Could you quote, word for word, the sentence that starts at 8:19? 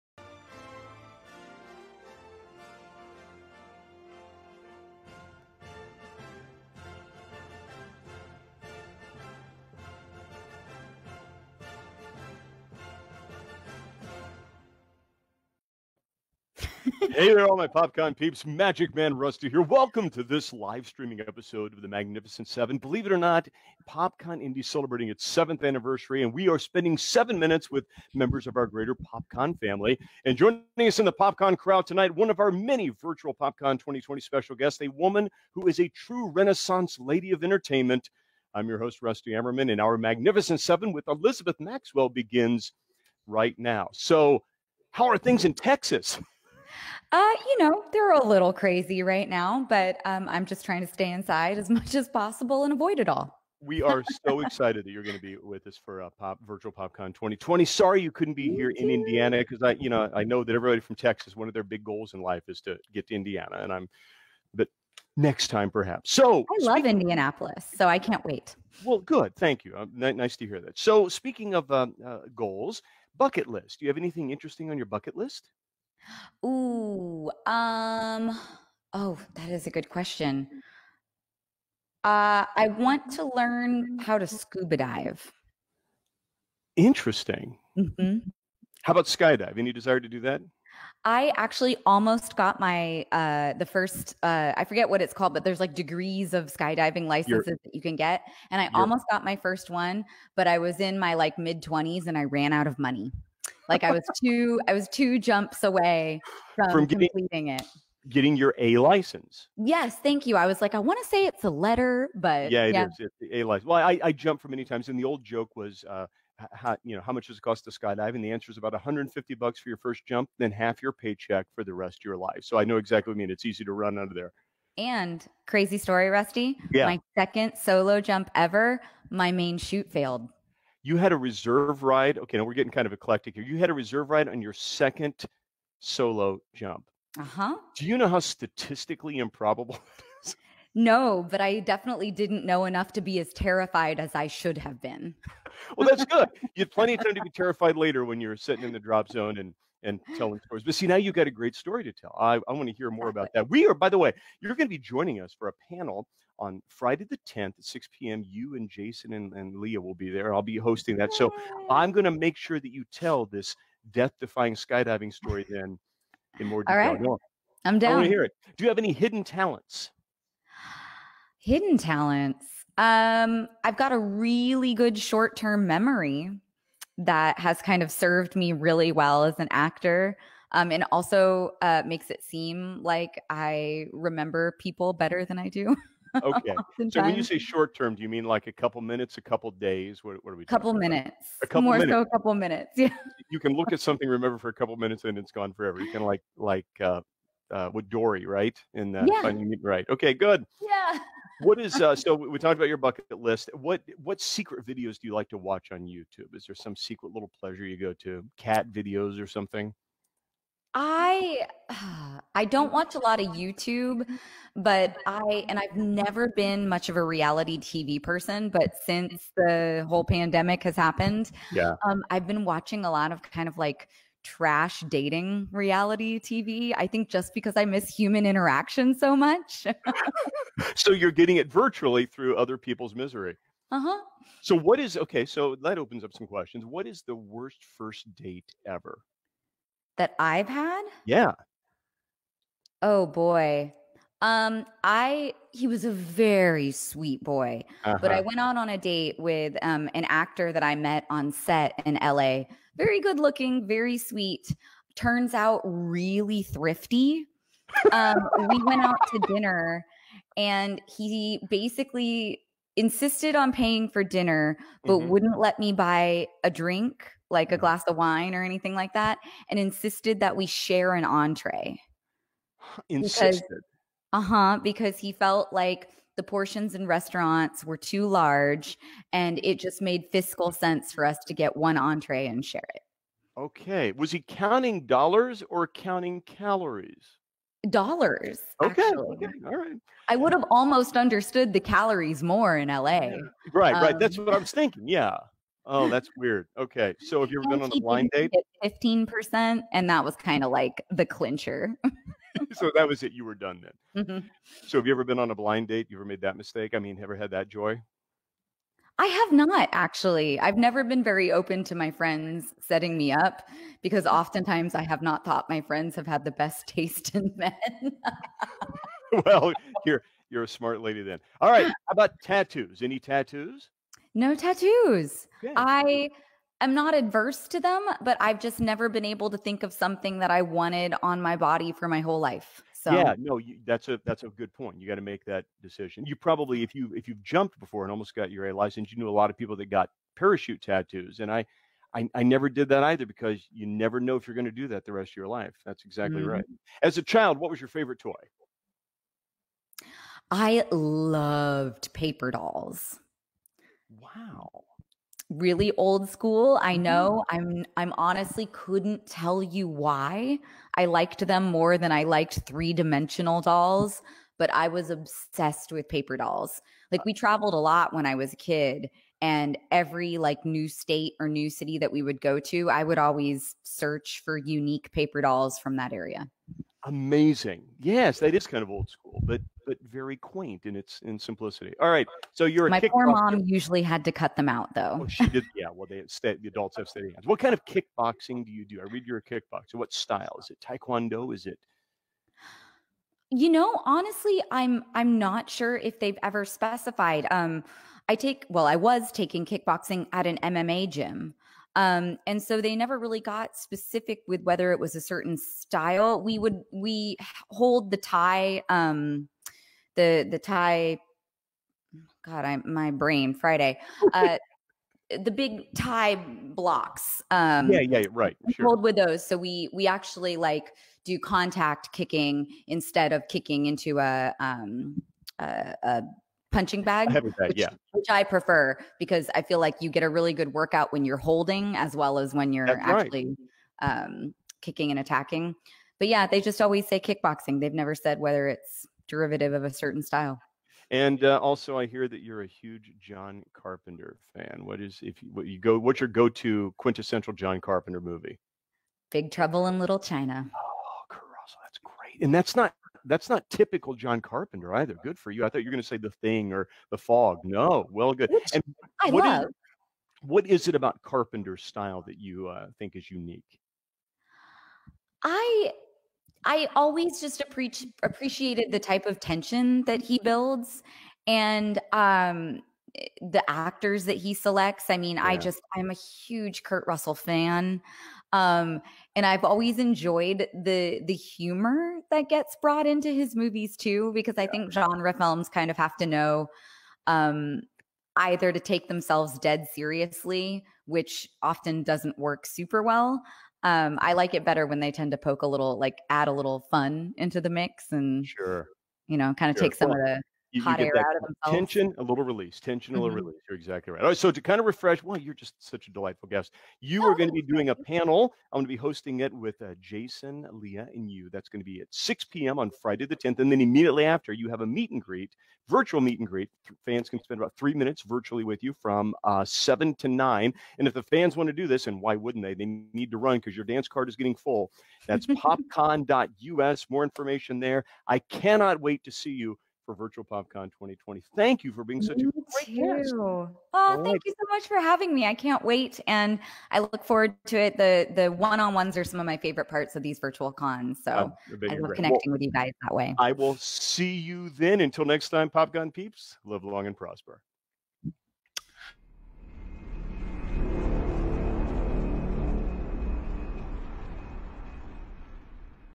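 take some well, of the you, hot you air out of themselves.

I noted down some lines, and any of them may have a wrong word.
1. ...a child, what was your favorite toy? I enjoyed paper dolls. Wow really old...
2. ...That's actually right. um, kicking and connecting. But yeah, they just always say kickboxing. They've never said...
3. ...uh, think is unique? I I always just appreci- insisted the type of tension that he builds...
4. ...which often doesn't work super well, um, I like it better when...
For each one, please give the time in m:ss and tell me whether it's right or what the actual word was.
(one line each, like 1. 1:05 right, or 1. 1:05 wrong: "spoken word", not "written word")
1. 5:46 wrong: "loved", not "enjoyed"
2. 7:12 wrong: "attacking", not "connecting"
3. 7:42 wrong: "appreciated", not "insisted"
4. 8:10 right.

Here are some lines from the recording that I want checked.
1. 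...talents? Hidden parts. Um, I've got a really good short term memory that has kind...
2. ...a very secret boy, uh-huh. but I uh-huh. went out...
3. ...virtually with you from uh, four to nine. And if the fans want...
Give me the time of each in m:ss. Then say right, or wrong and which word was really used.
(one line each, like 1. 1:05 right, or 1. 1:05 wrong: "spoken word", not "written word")
1. 2:49 wrong: "talents", not "parts"
2. 4:05 wrong: "sweet", not "secret"
3. 8:38 wrong: "seven", not "four".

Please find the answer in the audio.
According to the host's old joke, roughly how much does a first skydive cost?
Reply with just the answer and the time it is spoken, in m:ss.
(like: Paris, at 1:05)
150 bucks, at 1:58.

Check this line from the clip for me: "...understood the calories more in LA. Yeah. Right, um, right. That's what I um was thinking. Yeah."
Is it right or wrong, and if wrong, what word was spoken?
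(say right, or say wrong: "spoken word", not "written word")
right.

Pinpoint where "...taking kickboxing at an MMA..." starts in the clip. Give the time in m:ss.
6:39.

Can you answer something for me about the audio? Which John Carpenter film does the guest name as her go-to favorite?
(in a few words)
Big Trouble in Little China.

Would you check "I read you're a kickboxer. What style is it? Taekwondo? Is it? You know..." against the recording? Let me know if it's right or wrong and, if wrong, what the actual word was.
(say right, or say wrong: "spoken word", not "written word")
right.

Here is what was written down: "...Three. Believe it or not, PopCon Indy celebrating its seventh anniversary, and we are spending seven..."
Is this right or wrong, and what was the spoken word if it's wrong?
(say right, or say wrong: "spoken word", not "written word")
wrong: "Seven", not "Three".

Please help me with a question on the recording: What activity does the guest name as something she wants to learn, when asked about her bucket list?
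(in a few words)
scuba dive.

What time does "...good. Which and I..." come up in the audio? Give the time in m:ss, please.
7:38.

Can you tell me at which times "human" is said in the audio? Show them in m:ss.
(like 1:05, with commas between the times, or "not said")
3:47.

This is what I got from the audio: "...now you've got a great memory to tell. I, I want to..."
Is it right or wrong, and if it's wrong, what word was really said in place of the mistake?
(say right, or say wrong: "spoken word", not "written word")
wrong: "story", not "memory".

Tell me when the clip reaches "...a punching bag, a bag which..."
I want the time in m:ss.
7:05.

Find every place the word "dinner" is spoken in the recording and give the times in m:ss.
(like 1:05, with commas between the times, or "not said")
4:19, 4:24.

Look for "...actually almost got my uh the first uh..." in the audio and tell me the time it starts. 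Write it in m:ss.
1:31.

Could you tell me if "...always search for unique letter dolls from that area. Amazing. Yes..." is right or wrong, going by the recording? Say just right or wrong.
wrong.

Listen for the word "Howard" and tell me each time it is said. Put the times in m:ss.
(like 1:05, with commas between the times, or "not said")
not said.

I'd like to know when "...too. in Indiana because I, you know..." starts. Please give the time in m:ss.
0:58.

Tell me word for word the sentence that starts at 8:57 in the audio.
the The one on ones are some of my favorite parts of these virtual cons.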